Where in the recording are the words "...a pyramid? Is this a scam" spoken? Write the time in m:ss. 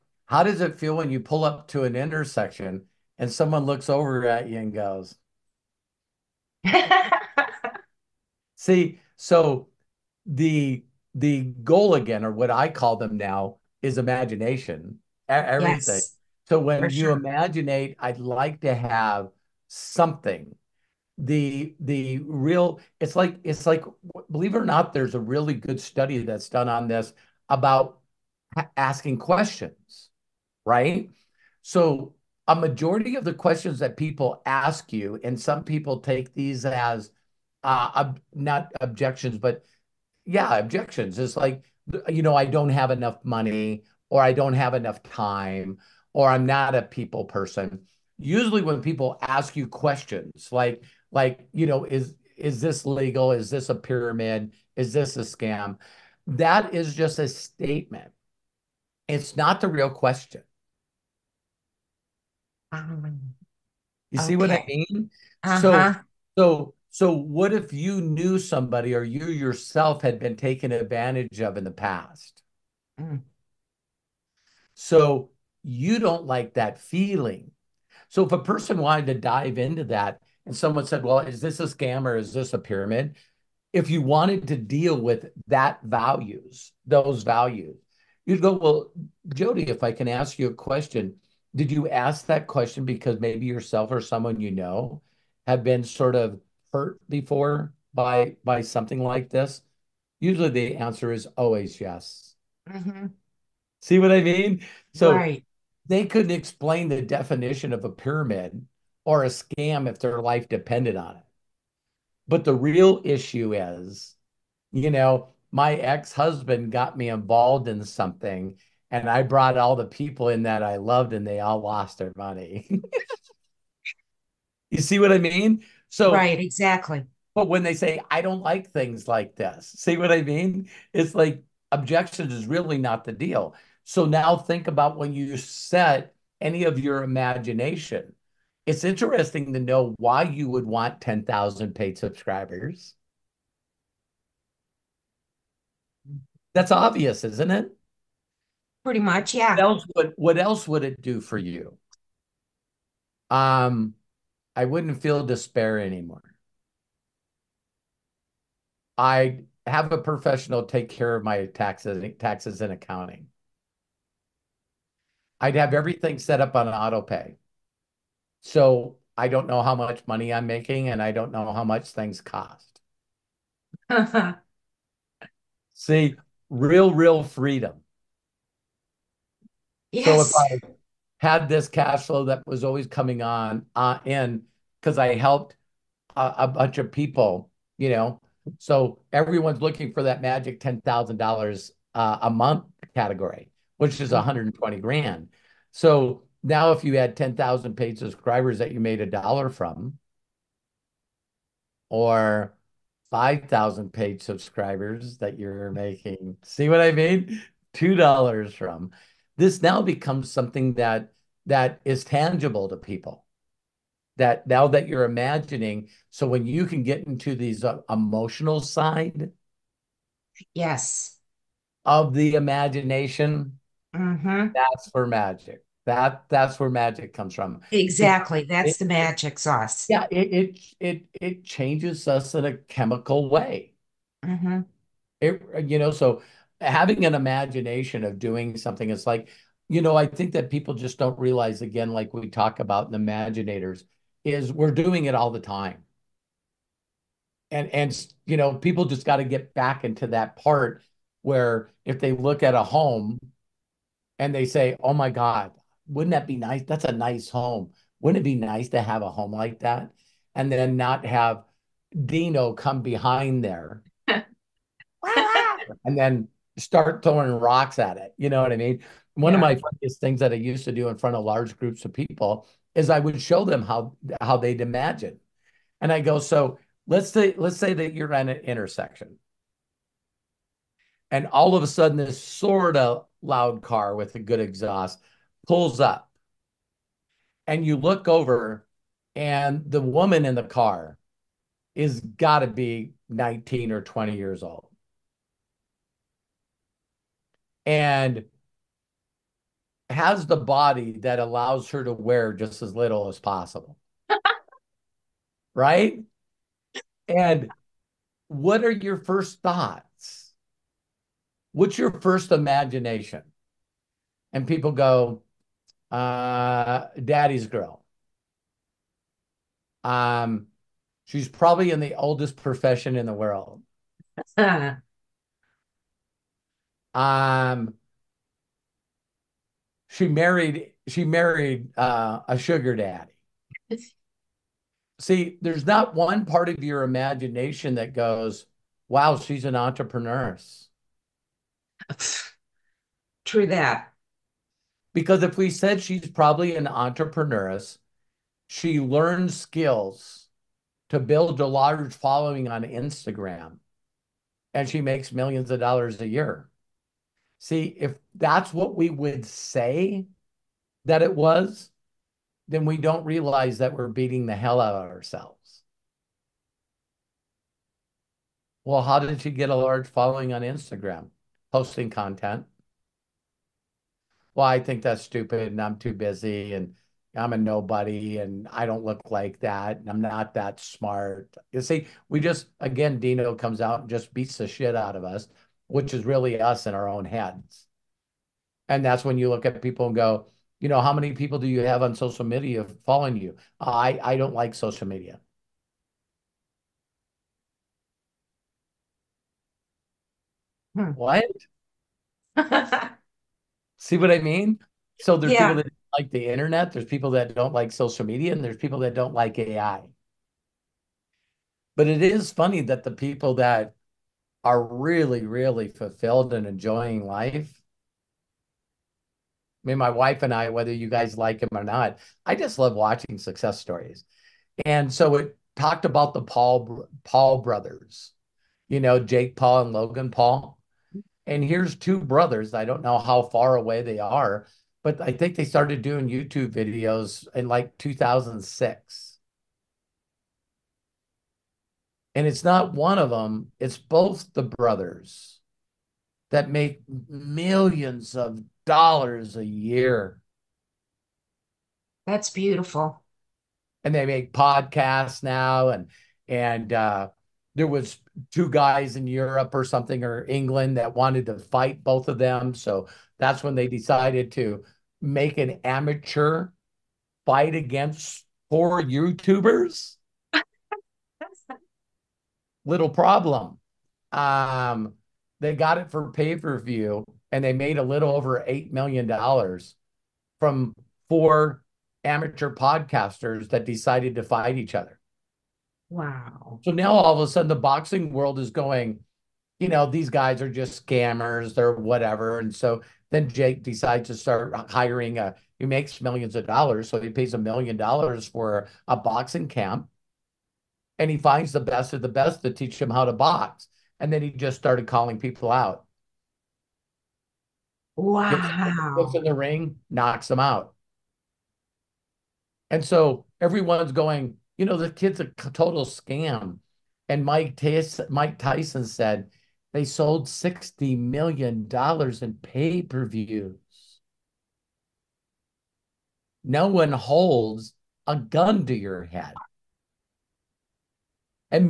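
0:53.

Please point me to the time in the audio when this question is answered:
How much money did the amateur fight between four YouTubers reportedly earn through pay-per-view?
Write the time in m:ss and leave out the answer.
7:57.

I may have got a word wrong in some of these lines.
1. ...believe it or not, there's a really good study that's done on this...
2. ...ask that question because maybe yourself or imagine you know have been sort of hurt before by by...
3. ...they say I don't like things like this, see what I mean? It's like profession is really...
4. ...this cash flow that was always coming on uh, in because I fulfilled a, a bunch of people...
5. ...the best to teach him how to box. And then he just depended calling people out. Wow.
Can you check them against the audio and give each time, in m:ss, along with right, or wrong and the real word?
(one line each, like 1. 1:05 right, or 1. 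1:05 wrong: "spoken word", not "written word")
1. 0:24 right
2. 1:31 wrong: "someone", not "imagine"
3. 2:07 wrong: "objection", not "profession"
4. 3:01 wrong: "helped", not "fulfilled"
5. 8:22 wrong: "started", not "depended".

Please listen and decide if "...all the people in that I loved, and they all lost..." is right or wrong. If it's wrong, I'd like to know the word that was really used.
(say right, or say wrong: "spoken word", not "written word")
right.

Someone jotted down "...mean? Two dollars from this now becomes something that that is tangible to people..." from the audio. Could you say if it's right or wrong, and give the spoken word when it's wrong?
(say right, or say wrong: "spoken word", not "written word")
right.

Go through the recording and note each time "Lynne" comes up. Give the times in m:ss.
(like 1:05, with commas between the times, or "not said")
not said.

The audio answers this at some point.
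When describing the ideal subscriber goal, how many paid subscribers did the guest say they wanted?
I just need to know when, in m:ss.
2:21.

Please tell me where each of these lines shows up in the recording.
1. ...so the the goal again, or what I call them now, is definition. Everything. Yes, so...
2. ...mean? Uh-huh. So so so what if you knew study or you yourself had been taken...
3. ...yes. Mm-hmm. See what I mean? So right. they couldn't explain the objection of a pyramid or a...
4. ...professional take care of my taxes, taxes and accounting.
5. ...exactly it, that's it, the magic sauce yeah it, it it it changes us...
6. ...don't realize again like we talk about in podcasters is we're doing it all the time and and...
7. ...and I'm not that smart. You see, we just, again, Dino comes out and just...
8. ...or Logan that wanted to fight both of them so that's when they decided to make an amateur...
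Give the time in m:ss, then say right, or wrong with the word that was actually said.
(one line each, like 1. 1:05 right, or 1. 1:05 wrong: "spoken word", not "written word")
1. 0:09 wrong: "imagination", not "definition"
2. 1:04 wrong: "somebody", not "study"
3. 1:41 wrong: "definition", not "objection"
4. 2:39 right
5. 3:47 right
6. 4:00 wrong: "imaginators", not "podcasters"
7. 6:19 right
8. 7:40 wrong: "England", not "Logan".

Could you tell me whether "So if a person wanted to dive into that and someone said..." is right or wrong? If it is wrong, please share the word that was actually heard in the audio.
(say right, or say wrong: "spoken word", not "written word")
right.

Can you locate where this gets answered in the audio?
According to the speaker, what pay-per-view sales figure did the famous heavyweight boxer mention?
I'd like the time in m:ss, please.
8:40.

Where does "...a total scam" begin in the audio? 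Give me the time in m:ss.
8:35.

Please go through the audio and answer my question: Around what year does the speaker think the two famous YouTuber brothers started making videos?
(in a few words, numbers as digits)
2006.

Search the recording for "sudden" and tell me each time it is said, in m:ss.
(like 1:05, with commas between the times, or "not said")
4:41, 8:07.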